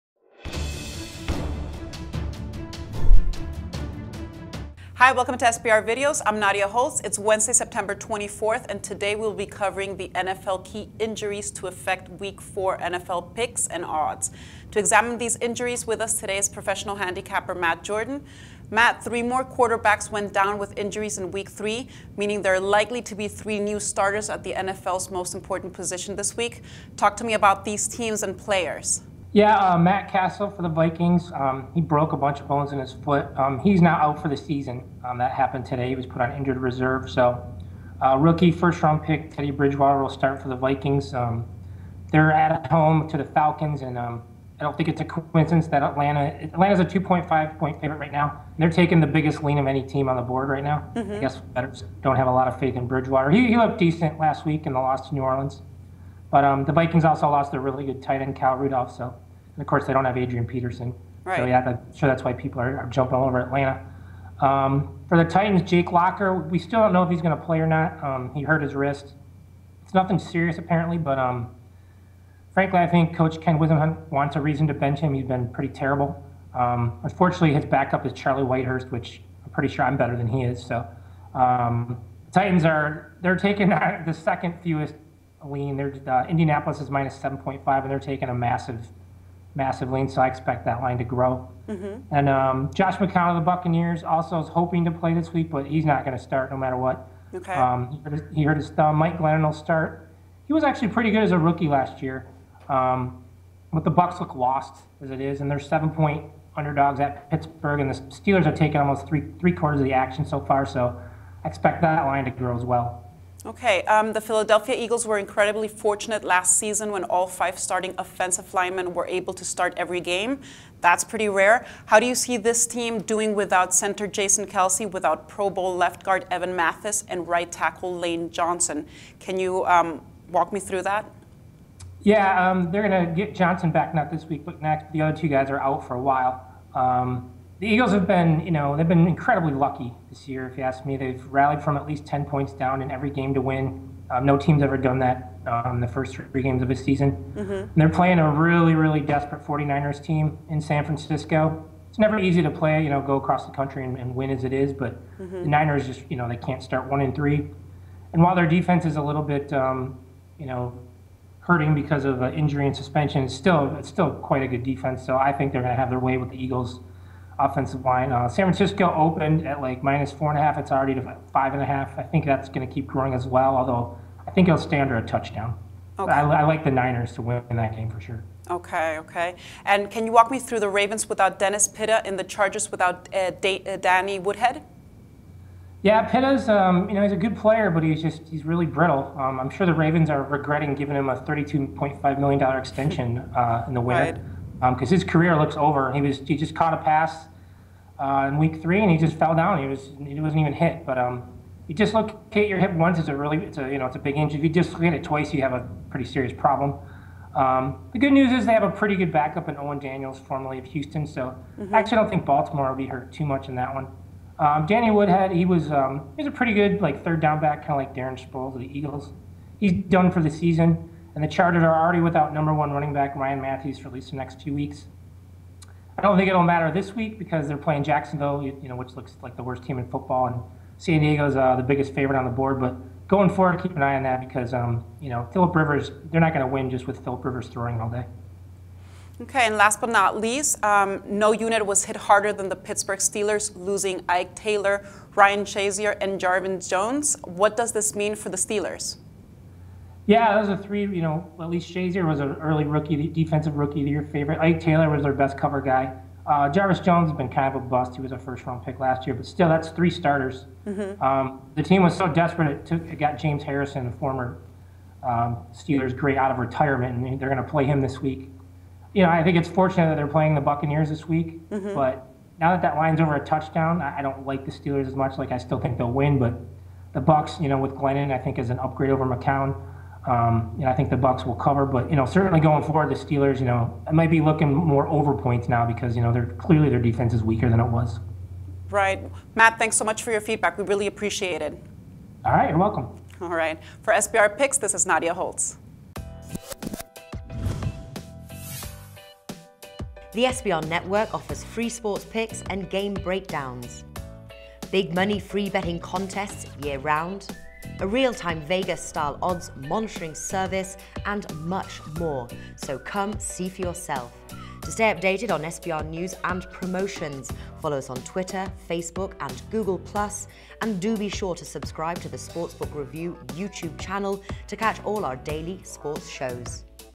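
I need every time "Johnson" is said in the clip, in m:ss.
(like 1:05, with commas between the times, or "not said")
2:08, 2:13.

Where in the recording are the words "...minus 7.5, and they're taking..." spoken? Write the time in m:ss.
1:26.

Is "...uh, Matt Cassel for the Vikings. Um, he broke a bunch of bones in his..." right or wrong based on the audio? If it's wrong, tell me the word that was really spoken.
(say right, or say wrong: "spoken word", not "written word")
right.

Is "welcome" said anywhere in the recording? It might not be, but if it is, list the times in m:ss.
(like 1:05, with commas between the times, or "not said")
0:05, 4:52.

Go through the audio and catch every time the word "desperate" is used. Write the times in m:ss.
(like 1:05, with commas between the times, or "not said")
2:28, 4:22.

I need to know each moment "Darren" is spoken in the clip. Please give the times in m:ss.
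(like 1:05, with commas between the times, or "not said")
3:37.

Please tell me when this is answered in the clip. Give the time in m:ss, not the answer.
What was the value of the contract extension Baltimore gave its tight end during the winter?
3:11.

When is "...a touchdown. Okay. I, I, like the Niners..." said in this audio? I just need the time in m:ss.
2:54.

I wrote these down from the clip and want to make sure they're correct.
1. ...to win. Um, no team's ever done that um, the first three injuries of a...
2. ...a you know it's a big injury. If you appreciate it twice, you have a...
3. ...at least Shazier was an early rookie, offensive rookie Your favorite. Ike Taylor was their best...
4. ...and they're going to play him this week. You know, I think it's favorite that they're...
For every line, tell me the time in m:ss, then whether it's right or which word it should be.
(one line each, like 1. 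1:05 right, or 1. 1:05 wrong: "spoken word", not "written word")
1. 2:23 wrong: "games", not "injuries"
2. 3:23 wrong: "dislocate", not "appreciate"
3. 4:11 wrong: "defensive", not "offensive"
4. 4:26 wrong: "fortunate", not "favorite".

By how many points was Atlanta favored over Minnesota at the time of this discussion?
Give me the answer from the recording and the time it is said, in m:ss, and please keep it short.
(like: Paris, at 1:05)
2.5, at 0:46.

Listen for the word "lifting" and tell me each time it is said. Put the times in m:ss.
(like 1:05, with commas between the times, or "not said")
not said.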